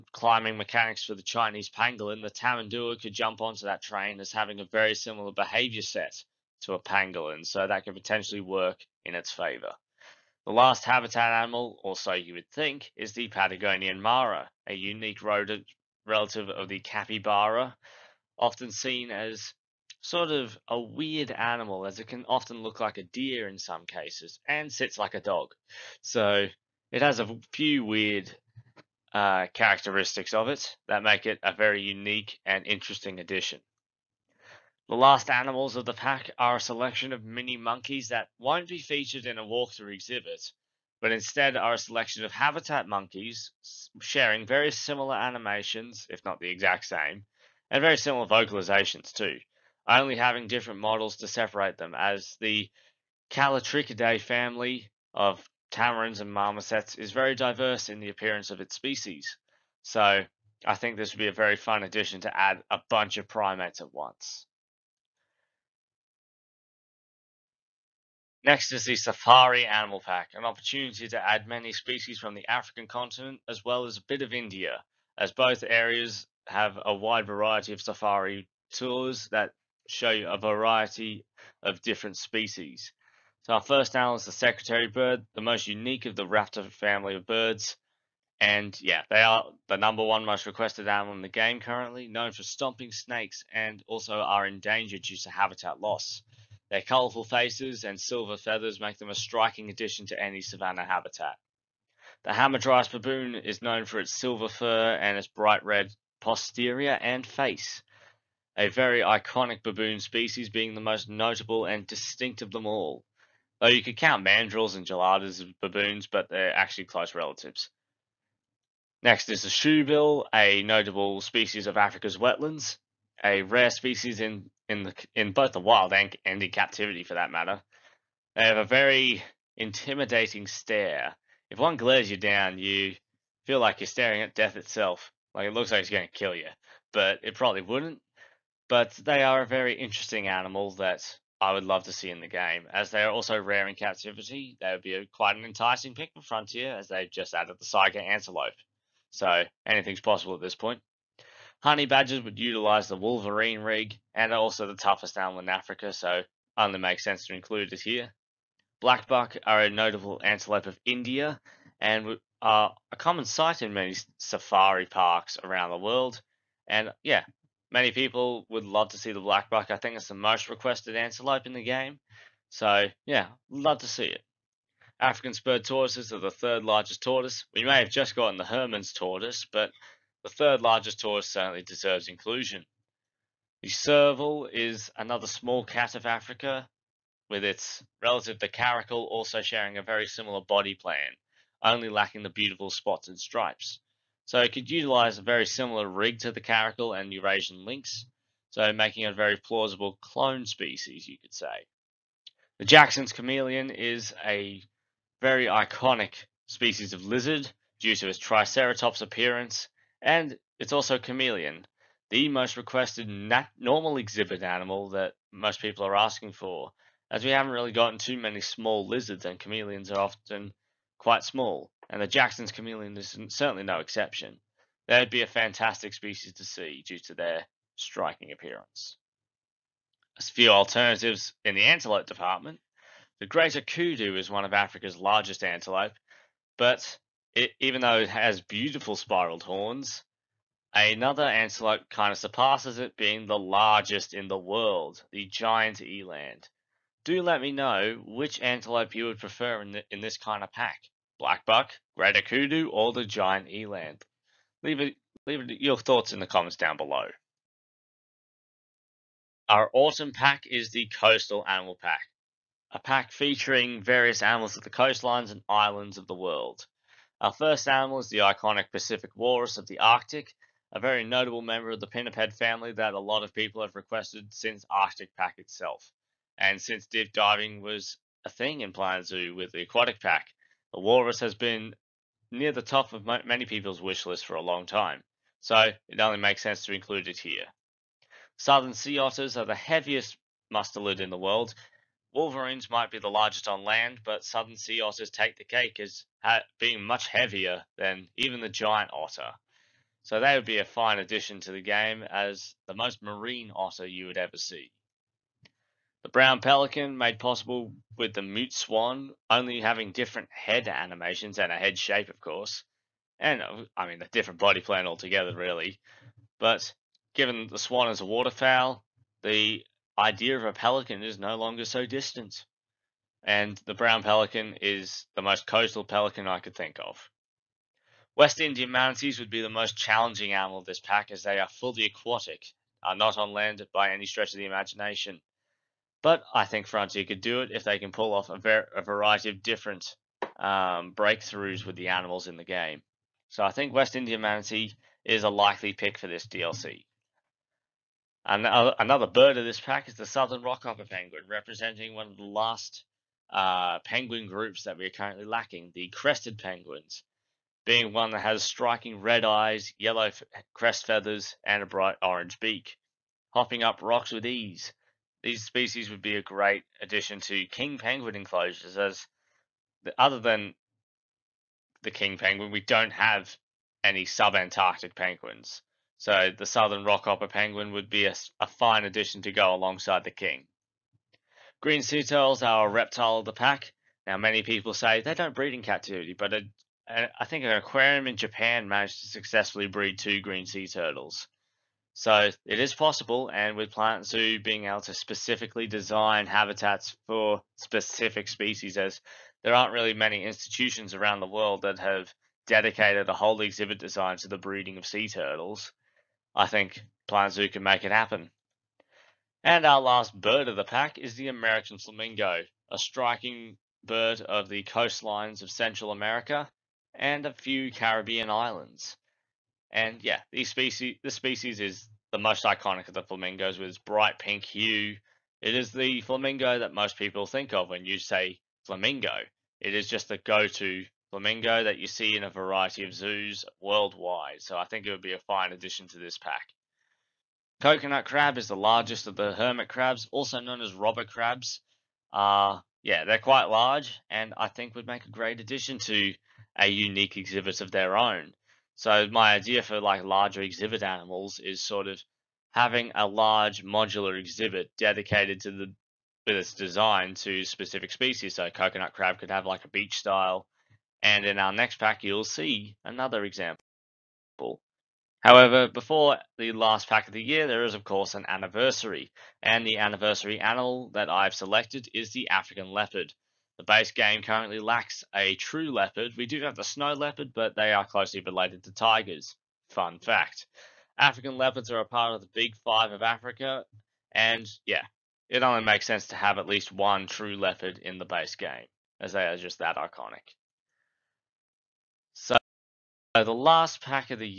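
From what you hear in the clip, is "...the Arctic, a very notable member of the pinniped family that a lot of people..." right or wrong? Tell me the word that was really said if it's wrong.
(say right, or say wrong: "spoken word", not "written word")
right.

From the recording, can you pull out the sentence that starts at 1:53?
Though you could count mandrills and geladas as baboons, but they're actually close relatives.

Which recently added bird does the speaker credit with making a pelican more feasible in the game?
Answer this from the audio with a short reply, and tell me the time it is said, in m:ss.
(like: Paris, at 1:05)
Mute swan, at 5:08.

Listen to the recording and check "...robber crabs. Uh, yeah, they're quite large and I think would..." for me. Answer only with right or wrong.
right.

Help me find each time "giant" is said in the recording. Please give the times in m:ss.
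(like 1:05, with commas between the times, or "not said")
4:05, 4:13, 4:58.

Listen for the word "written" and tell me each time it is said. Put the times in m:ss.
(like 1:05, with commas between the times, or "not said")
not said.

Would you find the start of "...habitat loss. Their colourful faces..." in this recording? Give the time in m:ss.
1:35.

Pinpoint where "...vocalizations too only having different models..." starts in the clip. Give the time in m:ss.
0:48.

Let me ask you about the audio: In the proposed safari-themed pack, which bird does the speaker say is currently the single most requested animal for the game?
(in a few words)
Secretary bird.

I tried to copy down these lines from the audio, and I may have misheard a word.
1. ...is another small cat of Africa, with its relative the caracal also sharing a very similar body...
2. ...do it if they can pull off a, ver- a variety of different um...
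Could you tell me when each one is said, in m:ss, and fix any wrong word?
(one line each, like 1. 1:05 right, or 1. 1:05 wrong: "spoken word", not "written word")
1. 3:04 right
2. 5:37 right.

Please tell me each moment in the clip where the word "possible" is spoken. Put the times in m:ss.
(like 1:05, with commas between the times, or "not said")
2:30, 5:07, 6:32.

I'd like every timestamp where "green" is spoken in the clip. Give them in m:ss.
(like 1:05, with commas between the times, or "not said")
6:21, 6:30.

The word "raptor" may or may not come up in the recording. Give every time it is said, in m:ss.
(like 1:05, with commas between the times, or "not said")
1:26.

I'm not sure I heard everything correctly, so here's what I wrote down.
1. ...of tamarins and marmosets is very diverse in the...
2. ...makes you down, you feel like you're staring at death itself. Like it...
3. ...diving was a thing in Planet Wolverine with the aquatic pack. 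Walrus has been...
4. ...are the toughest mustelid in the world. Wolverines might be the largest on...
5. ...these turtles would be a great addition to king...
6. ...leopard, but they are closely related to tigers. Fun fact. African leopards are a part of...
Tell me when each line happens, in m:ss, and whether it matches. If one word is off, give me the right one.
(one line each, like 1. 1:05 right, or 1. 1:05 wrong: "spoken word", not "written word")
1. 0:55 right
2. 2:11 wrong: "glares", not "makes"
3. 4:37 wrong: "Zoo", not "Wolverine"
4. 4:49 wrong: "heaviest", not "toughest"
5. 6:05 wrong: "species", not "turtles"
6. 7:56 right.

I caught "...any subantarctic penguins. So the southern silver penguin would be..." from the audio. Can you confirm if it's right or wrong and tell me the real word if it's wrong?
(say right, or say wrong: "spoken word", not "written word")
wrong: "rockhopper", not "silver".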